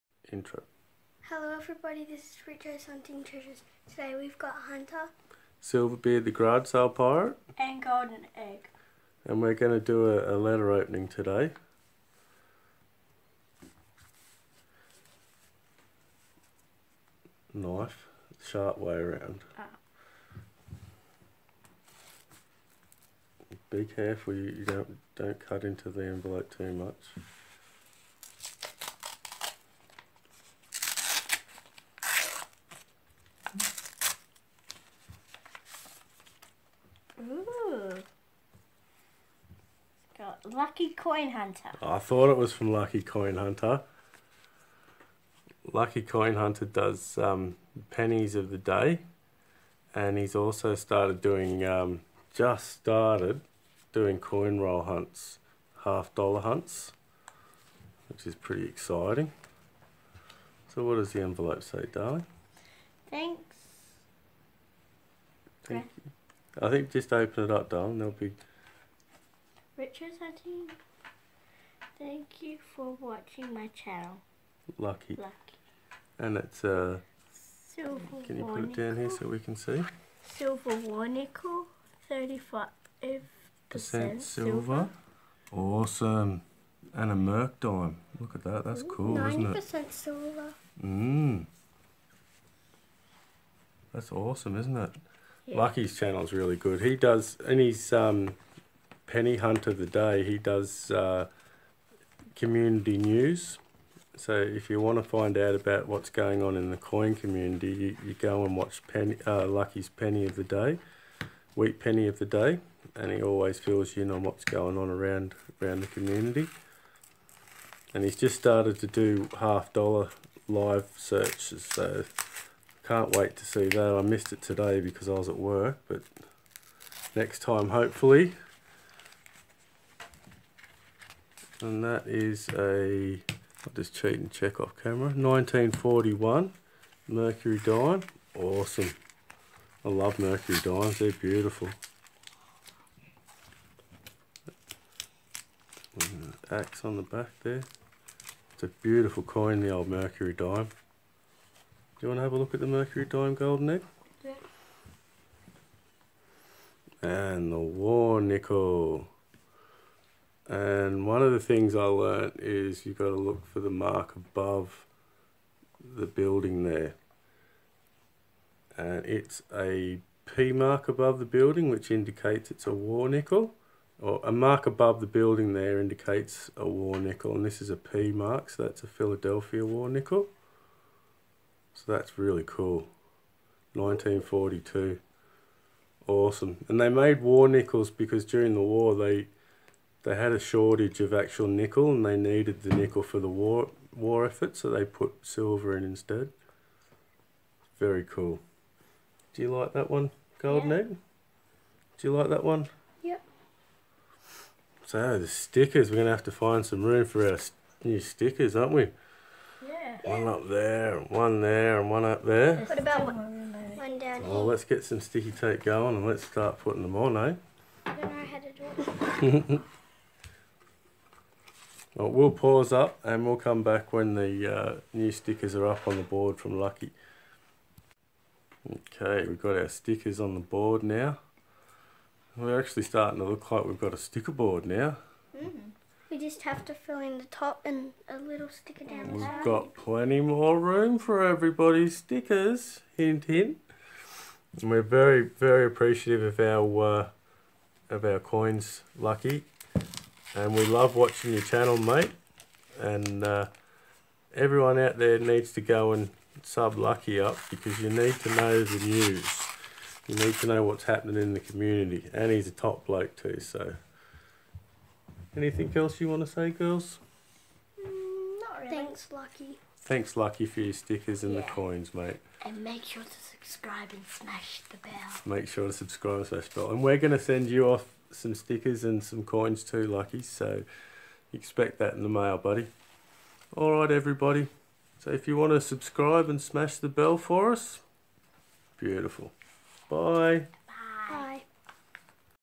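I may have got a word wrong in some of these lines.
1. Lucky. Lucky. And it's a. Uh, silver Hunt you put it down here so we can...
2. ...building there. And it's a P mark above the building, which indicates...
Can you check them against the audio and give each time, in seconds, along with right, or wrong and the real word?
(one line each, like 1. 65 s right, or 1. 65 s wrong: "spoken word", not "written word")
1. 74 s wrong: "Can", not "Hunt"
2. 166 s right.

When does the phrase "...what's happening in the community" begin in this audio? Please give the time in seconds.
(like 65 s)
260 s.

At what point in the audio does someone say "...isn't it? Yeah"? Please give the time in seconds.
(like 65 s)
94 s.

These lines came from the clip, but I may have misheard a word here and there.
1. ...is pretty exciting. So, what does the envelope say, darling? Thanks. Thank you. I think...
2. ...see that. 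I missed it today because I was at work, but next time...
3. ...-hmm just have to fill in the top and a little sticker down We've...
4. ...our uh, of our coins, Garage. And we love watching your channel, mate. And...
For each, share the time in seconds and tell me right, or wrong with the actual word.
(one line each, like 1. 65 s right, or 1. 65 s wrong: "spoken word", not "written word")
1. 58 s right
2. 123 s right
3. 235 s right
4. 246 s wrong: "Lucky", not "Garage".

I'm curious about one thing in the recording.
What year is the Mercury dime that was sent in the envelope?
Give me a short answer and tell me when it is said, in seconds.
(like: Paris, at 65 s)
1941, at 135 s.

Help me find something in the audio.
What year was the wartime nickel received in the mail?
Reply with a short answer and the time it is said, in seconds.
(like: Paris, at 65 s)
1942, at 183 s.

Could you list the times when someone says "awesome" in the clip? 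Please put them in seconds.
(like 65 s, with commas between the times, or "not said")
85 s, 94 s, 138 s, 186 s.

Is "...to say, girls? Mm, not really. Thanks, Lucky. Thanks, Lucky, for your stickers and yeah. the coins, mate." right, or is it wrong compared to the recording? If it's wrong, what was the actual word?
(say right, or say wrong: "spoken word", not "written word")
right.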